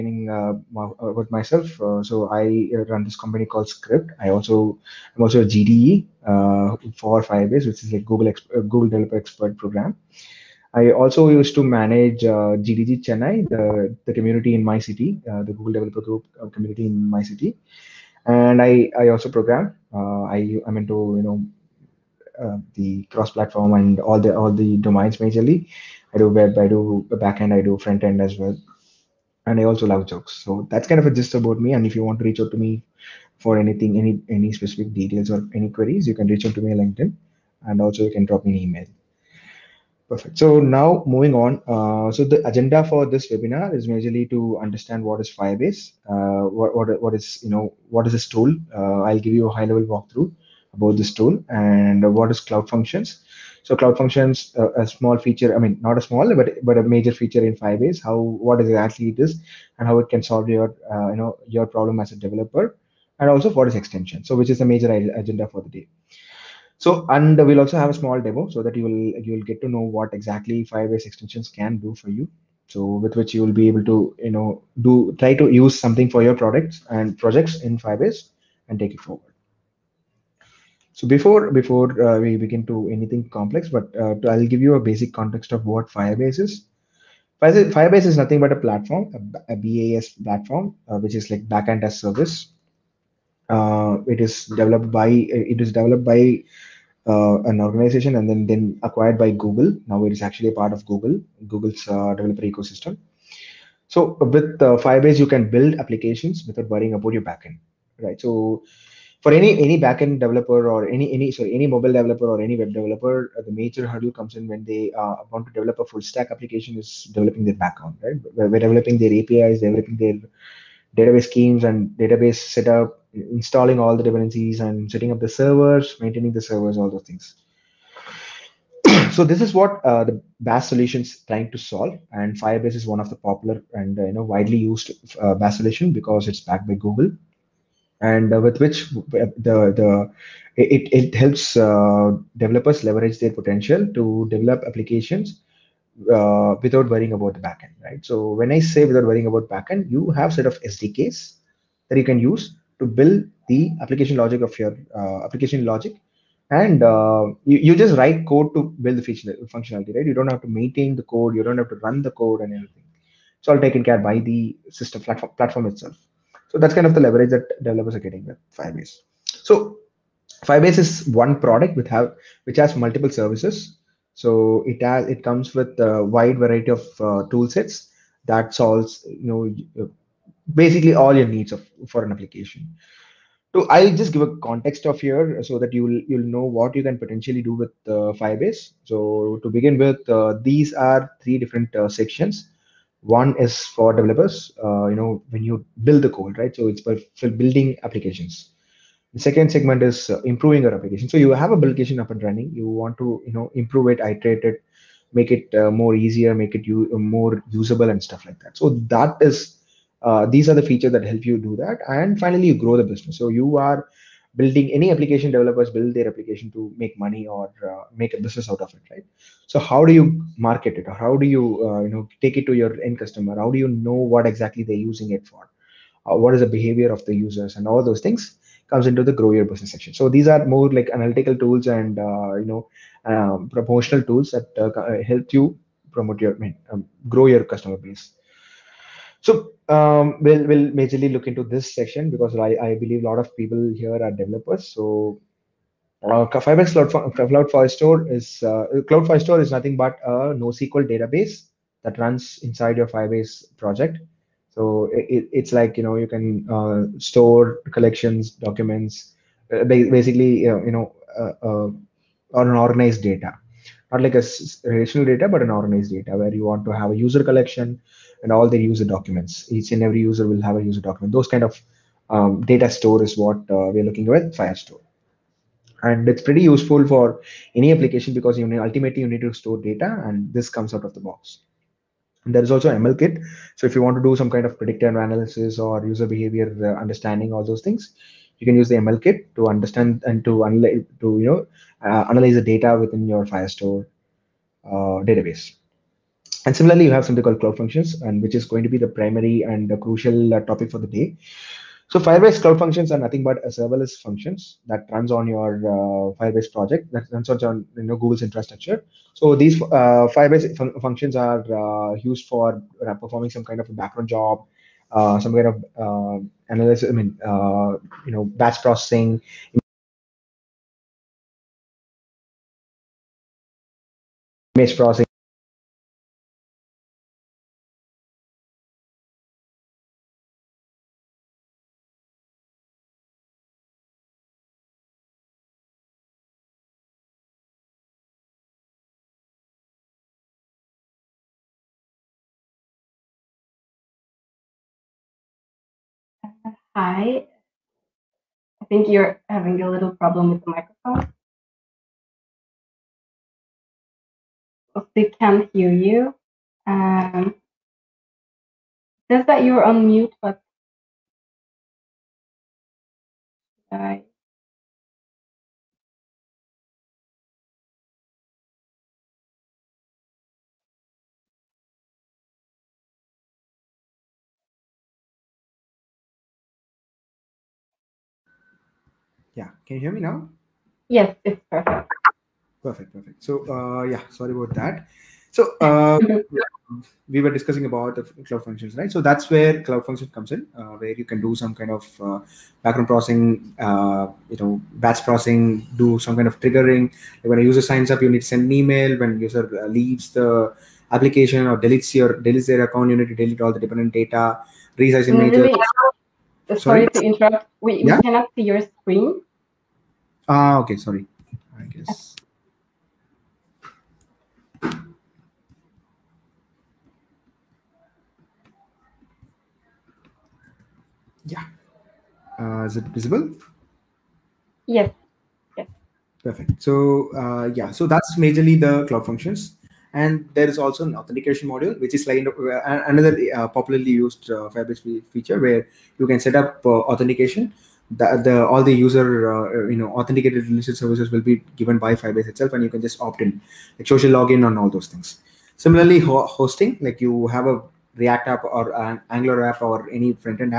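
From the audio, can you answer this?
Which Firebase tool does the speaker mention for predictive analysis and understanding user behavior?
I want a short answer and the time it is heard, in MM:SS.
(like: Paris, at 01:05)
ML Kit, at 04:42.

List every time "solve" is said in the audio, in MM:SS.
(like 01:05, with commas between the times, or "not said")
01:00, 02:11, 02:58.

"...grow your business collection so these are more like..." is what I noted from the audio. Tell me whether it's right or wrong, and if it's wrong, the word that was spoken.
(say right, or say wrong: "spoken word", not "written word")
wrong: "section", not "collection".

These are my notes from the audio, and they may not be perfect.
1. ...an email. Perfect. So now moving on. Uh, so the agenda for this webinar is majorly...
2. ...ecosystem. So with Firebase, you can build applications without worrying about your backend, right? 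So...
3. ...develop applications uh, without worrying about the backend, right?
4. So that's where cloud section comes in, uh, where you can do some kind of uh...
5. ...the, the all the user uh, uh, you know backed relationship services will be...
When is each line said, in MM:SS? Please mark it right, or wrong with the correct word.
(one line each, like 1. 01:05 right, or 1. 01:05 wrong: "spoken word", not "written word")
1. 00:38 right
2. 01:42 right
3. 02:24 right
4. 06:28 wrong: "function", not "section"
5. 07:17 wrong: "authenticated", not "backed".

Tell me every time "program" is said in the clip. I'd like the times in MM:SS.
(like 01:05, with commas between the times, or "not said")
00:09, 00:19.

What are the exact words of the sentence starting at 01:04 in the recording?
So which is the major agenda for the day.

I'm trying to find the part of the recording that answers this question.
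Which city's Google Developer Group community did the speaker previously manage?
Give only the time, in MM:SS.
00:12.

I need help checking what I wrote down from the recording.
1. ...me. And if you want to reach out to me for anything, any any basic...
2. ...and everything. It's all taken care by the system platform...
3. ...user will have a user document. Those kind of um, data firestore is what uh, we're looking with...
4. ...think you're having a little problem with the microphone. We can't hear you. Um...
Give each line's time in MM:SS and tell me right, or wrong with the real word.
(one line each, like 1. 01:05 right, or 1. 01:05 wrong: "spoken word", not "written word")
1. 00:31 wrong: "specific", not "basic"
2. 02:42 right
3. 04:30 wrong: "store", not "firestore"
4. 05:48 right.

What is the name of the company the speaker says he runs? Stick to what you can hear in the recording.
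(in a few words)
Skcript.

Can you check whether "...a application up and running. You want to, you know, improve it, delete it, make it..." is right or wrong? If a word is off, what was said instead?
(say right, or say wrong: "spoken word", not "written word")
wrong: "iterate", not "delete".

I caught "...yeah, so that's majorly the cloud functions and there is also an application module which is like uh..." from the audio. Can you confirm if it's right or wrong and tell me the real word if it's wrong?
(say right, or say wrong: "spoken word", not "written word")
wrong: "authentication", not "application".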